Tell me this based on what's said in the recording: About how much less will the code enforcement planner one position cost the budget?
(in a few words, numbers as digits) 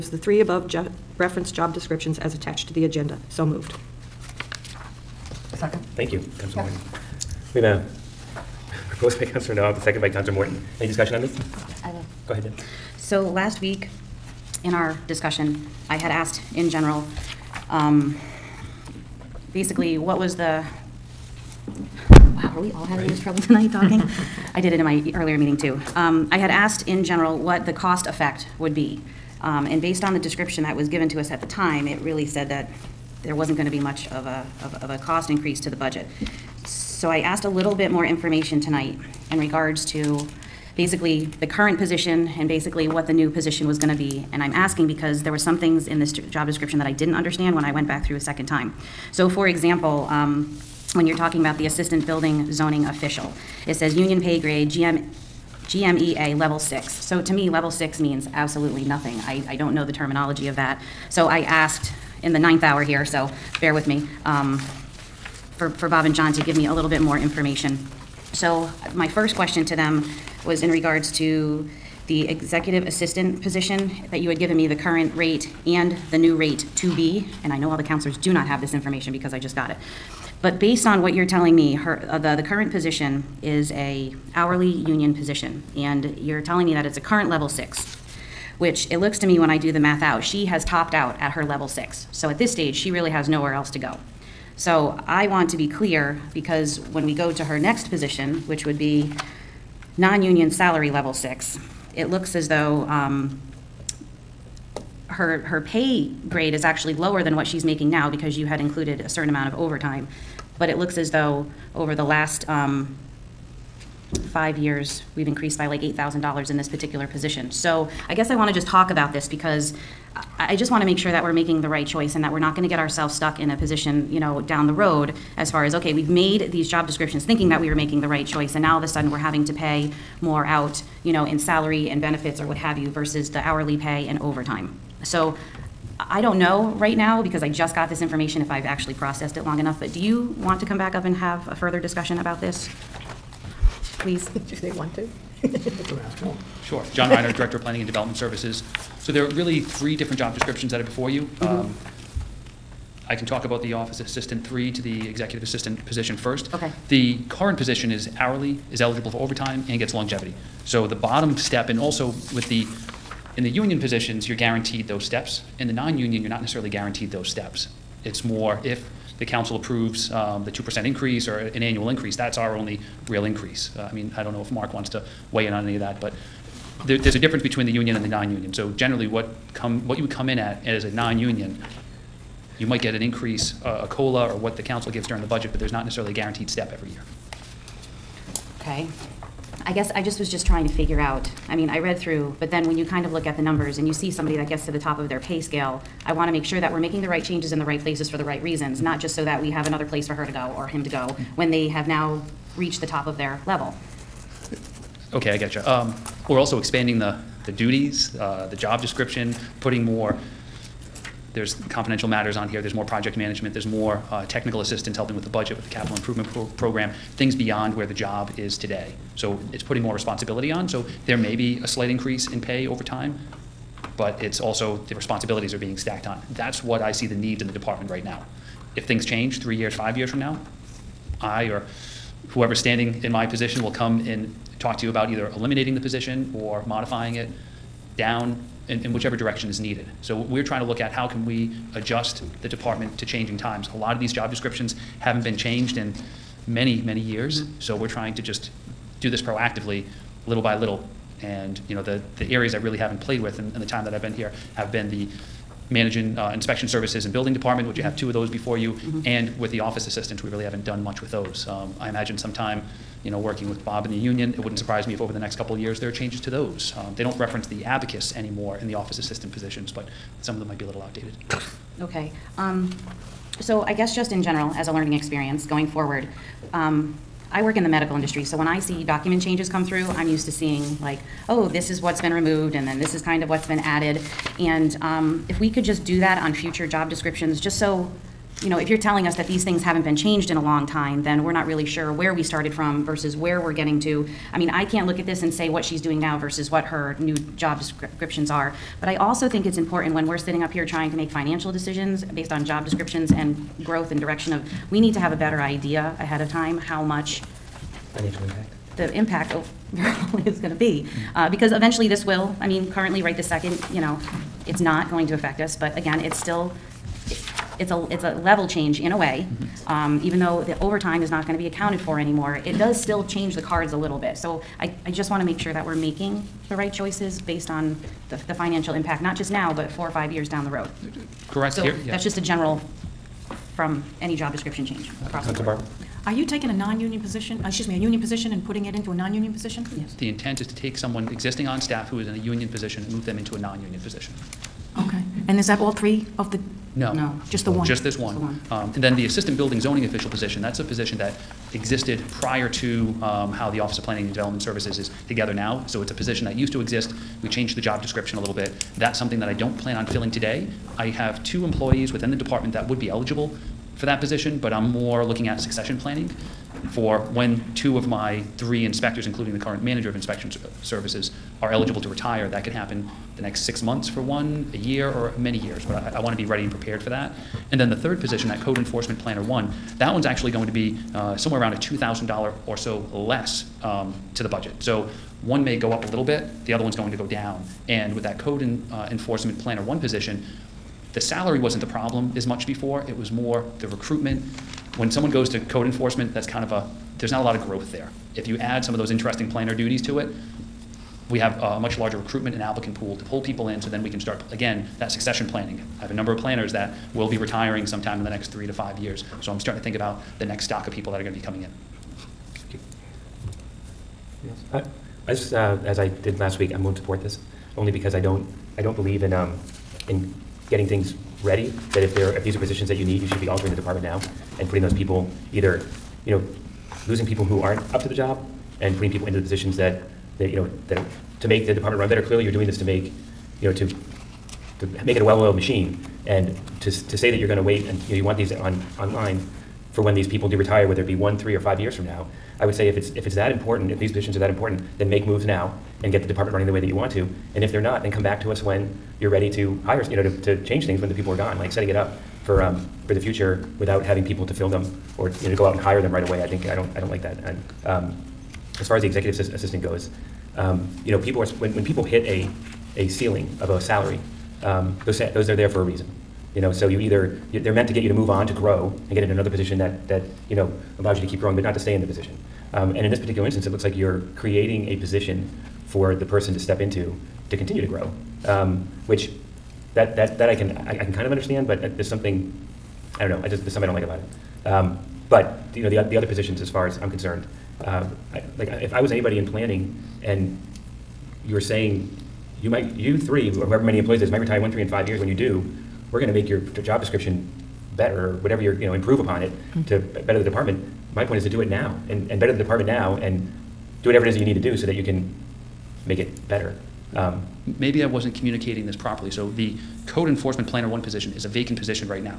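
$2,000.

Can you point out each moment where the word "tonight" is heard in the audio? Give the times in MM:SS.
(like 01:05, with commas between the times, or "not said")
00:23, 00:38.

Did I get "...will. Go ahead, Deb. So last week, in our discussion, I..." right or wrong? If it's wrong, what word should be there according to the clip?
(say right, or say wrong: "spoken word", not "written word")
right.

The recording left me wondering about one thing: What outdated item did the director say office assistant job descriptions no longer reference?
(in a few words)
the abacus.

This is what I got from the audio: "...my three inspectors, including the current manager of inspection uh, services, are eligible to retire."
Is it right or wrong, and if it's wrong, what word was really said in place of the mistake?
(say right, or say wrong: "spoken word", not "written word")
right.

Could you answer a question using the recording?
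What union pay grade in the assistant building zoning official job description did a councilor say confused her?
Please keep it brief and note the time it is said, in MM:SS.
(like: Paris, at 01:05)
GMEA level six, at 00:55.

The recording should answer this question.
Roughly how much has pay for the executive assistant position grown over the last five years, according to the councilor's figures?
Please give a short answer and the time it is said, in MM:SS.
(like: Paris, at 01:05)
$8,000, at 01:55.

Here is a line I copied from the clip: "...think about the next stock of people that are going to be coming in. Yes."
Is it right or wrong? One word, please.
right.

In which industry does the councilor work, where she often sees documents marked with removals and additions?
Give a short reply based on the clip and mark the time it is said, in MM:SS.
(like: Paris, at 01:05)
medical industry, at 04:37.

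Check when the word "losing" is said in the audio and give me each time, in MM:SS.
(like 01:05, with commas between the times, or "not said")
07:06.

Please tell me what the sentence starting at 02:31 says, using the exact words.
Um, I can talk about the office assistant three to the executive assistant position first.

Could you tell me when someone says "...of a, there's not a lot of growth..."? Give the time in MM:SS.
06:36.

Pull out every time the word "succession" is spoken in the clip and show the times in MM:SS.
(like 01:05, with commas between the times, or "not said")
06:05, 06:44.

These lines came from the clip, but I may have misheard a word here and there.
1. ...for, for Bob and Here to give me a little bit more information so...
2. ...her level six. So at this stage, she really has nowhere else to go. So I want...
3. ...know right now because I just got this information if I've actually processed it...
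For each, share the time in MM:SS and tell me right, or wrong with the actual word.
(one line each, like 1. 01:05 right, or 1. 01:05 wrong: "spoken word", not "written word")
1. 01:05 wrong: "John", not "Here"
2. 01:31 right
3. 02:16 right.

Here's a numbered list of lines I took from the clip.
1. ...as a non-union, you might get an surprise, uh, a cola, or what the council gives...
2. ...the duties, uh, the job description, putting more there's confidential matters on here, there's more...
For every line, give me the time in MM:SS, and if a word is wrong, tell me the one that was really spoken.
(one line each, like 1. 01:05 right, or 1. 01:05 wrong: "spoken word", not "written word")
1. 03:00 wrong: "increase", not "surprise"
2. 03:27 right.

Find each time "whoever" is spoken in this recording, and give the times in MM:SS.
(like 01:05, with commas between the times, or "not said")
03:52, 08:13.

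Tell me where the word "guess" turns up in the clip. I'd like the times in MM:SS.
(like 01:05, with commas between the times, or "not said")
01:58, 03:09, 04:33.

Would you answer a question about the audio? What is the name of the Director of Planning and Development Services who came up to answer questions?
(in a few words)
John Reiner.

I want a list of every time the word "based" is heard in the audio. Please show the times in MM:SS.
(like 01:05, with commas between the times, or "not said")
00:29, 01:20, 05:02, 05:27.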